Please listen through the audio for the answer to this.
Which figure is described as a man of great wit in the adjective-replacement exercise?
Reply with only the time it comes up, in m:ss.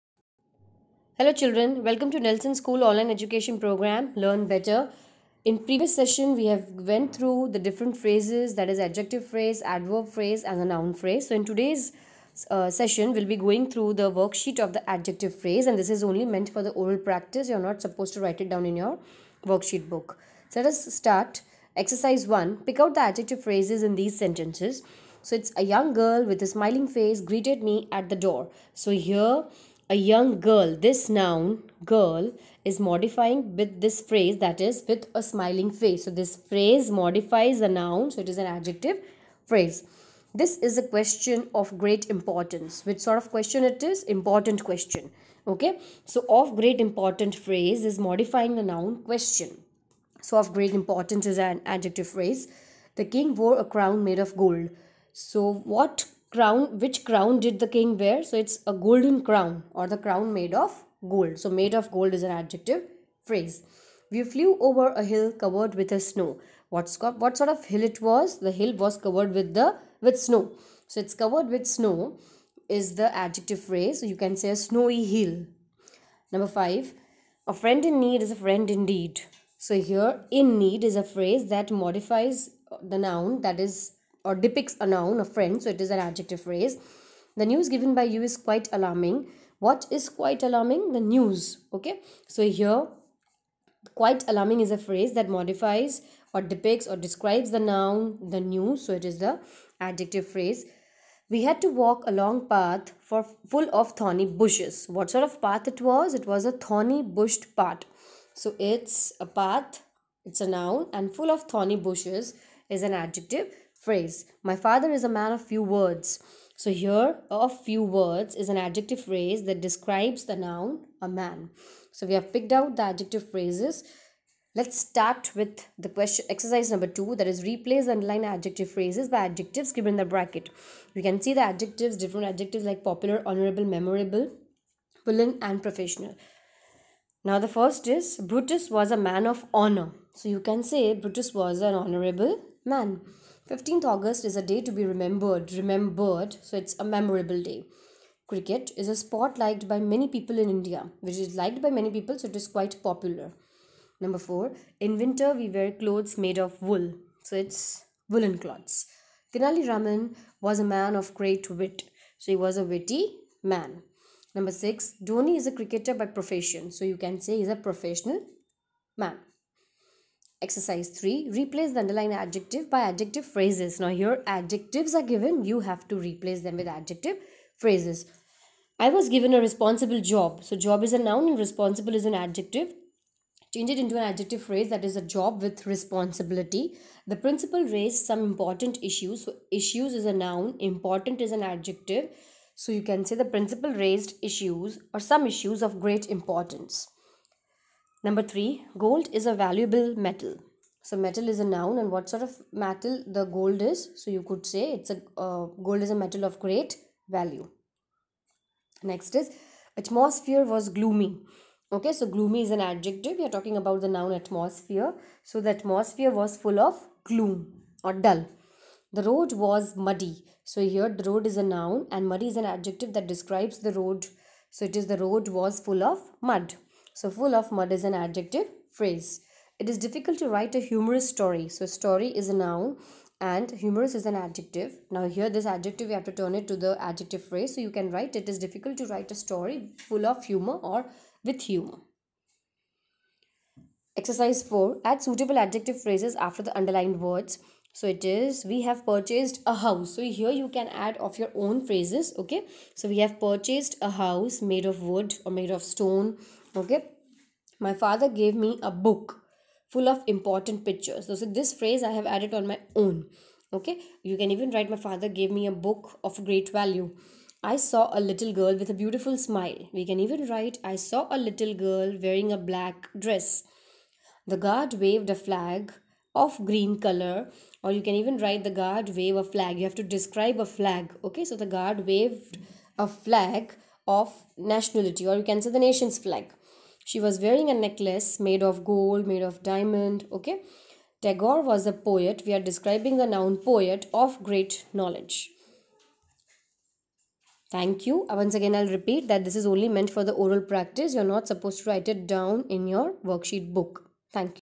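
2:39.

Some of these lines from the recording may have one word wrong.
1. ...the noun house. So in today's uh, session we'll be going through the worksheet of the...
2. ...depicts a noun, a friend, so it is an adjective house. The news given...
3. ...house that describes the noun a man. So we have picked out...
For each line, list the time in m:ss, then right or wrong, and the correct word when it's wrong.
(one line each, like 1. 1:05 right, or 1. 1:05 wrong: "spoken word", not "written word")
1. 0:10 wrong: "phrase", not "house"
2. 1:24 wrong: "phrase", not "house"
3. 1:59 wrong: "phrase", not "house".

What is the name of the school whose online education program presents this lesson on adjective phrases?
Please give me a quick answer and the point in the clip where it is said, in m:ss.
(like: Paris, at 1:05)
Nelson School, at 0:02.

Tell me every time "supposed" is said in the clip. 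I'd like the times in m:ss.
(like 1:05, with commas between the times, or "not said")
0:17, 5:01.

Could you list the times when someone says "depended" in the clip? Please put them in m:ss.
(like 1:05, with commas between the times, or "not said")
not said.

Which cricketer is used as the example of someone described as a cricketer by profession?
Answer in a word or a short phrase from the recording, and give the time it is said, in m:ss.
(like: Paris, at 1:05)
Dhoni, at 2:45.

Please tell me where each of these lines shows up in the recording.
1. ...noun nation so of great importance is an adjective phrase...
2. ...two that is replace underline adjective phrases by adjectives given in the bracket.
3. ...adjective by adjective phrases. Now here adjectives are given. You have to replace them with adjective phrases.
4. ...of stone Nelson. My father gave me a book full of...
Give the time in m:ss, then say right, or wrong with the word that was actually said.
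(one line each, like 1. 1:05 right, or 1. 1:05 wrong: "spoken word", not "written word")
1. 0:48 wrong: "question", not "nation"
2. 2:06 right
3. 2:52 right
4. 4:15 wrong: "Okay", not "Nelson".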